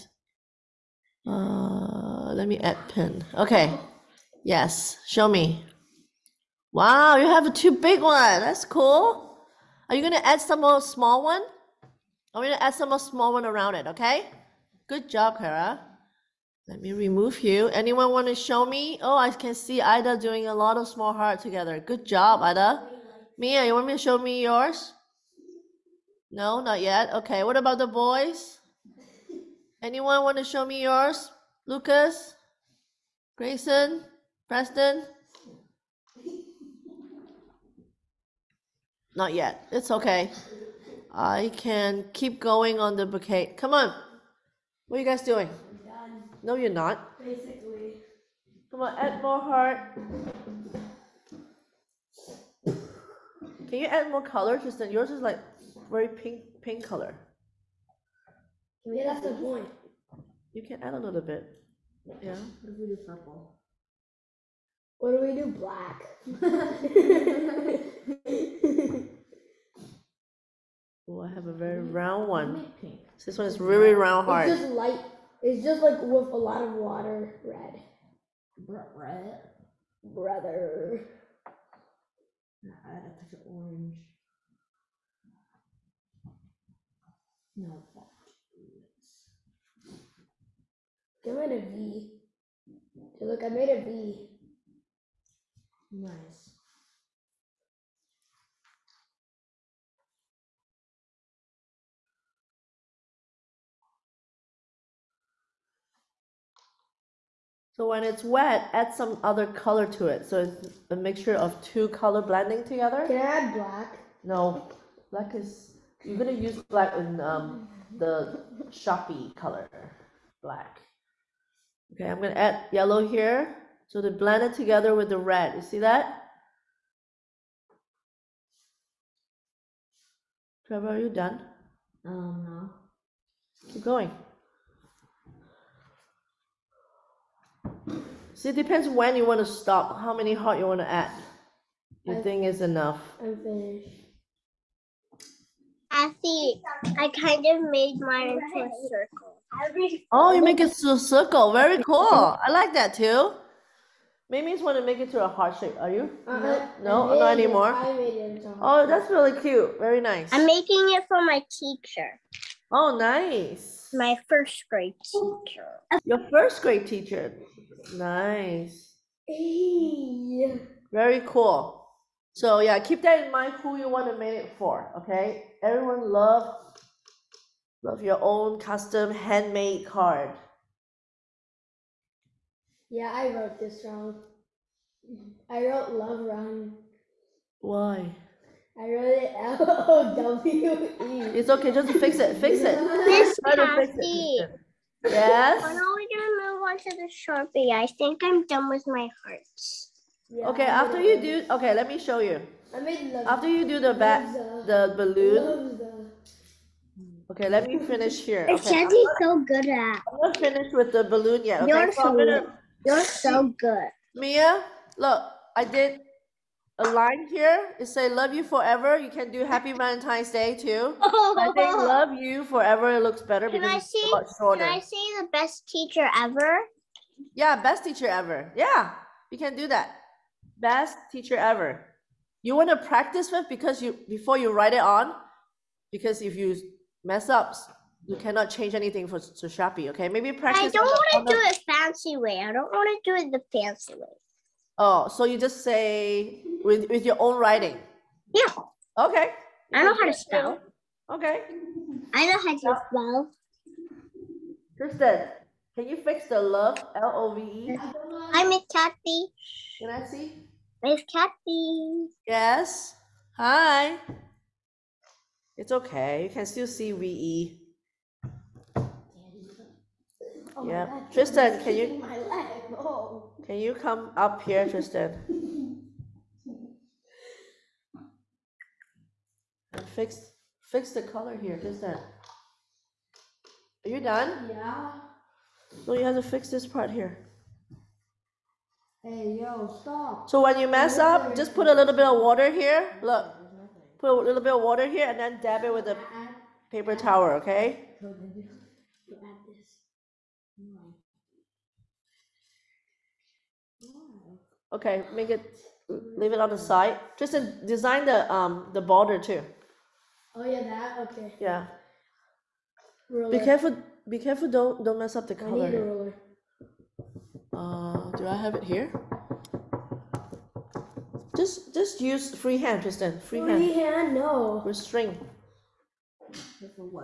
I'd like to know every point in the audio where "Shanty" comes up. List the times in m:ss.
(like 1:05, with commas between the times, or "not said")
3:28.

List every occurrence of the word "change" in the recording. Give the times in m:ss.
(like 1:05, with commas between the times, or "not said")
3:58.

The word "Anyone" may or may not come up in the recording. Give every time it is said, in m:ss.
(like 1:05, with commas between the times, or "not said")
0:17, 0:29.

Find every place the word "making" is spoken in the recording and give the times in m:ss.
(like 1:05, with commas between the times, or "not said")
2:40.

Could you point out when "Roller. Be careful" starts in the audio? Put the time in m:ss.
5:13.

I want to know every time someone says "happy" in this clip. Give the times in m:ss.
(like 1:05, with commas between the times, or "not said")
3:39.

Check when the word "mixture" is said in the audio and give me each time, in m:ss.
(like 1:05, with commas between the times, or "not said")
1:50.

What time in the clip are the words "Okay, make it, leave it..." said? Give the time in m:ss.
5:04.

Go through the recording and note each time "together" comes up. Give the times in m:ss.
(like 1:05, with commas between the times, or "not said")
0:21, 1:52, 2:04.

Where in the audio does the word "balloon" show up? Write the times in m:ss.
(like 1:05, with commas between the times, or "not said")
3:24, 3:31.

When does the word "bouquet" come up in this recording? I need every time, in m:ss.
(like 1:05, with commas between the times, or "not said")
0:43.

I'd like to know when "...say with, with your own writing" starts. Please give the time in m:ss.
4:05.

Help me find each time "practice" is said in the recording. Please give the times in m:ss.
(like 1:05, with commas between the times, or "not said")
3:52, 4:00.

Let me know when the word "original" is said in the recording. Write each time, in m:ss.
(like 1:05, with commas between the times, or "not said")
not said.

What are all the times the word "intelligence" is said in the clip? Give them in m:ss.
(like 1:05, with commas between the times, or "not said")
not said.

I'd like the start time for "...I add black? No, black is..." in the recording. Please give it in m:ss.
1:53.